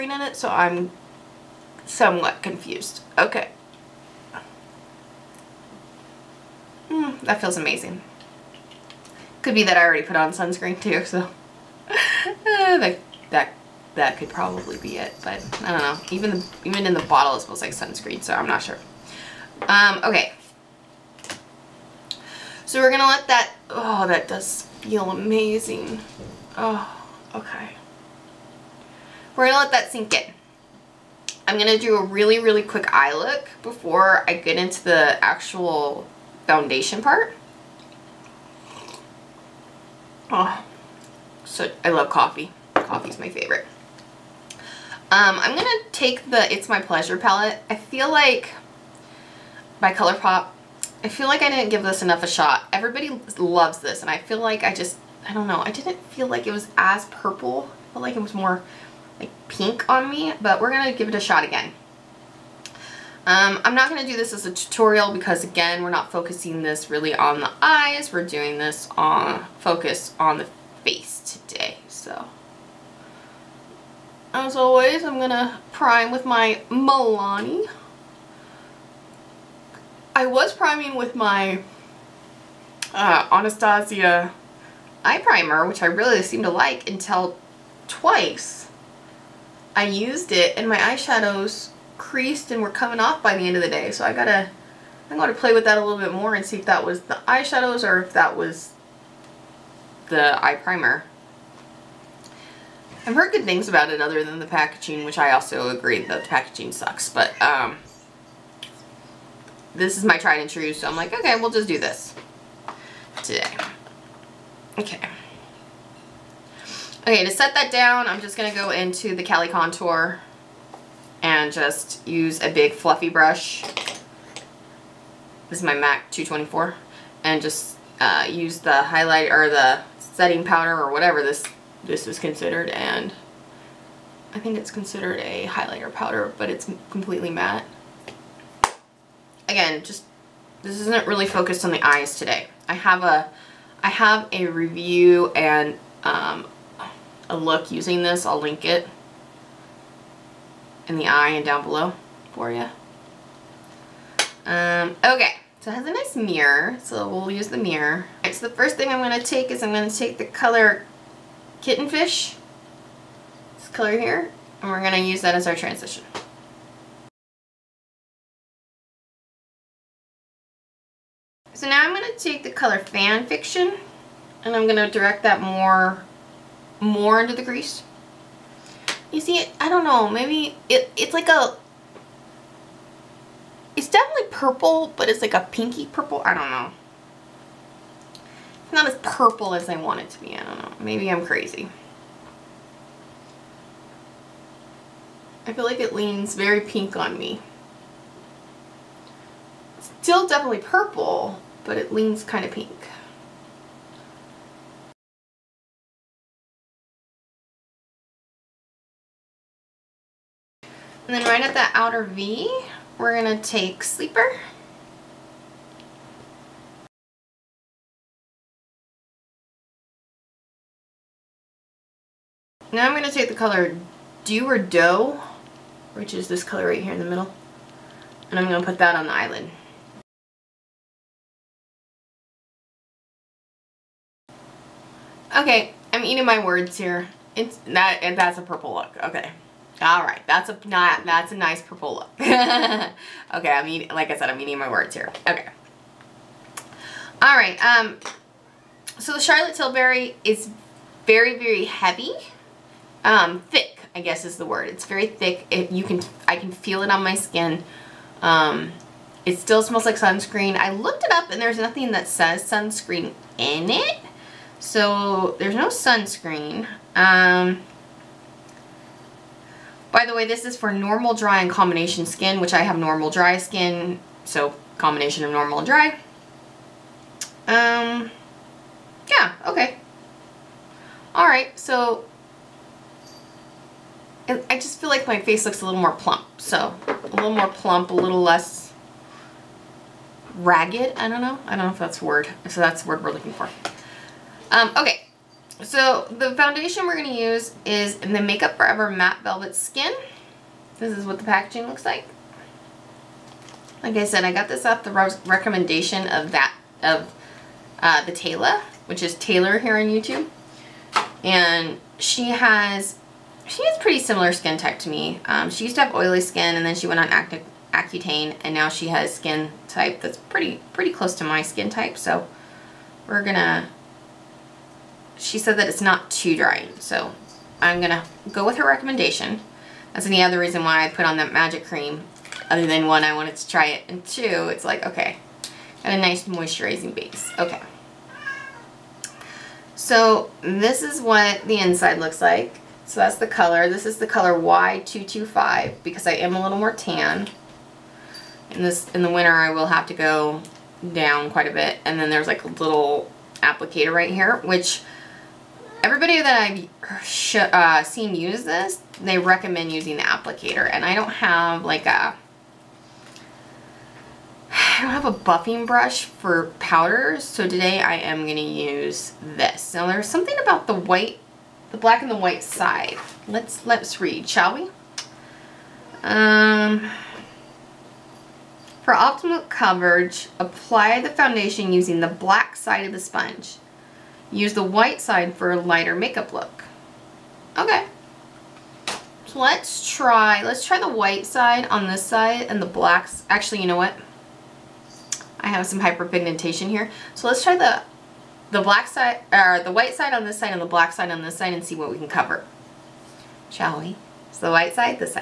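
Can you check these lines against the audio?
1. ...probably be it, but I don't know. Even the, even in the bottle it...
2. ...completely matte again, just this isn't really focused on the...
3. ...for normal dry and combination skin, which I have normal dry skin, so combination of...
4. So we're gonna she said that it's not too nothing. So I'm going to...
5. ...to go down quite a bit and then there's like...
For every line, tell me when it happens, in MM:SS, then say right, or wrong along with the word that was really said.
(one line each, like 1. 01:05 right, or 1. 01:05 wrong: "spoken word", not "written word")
1. 00:14 right
2. 02:16 right
3. 04:30 right
4. 05:21 wrong: "drying", not "nothing"
5. 05:49 right.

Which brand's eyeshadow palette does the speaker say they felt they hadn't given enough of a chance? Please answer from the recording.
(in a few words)
ColourPop.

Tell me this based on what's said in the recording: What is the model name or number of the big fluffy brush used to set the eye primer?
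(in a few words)
MAC 224.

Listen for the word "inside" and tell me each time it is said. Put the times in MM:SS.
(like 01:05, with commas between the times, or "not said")
05:41.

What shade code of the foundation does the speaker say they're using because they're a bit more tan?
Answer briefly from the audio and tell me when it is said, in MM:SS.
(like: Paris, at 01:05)
Y225, at 05:44.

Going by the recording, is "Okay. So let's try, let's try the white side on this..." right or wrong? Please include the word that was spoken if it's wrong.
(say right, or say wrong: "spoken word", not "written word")
right.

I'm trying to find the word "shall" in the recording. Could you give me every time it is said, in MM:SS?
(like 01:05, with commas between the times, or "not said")
06:14, 06:43.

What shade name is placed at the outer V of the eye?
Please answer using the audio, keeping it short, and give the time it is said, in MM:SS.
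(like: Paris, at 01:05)
Sleeper, at 03:33.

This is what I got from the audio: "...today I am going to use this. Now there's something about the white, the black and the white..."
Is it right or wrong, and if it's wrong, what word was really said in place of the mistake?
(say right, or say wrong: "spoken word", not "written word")
right.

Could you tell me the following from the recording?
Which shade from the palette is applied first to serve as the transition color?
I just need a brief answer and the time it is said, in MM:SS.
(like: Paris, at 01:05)
Kittenfish, at 02:41.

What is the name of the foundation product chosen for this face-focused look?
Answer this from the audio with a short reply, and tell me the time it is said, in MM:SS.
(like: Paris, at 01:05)
Matte Velvet Skin, at 04:58.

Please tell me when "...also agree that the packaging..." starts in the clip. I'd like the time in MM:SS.
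01:45.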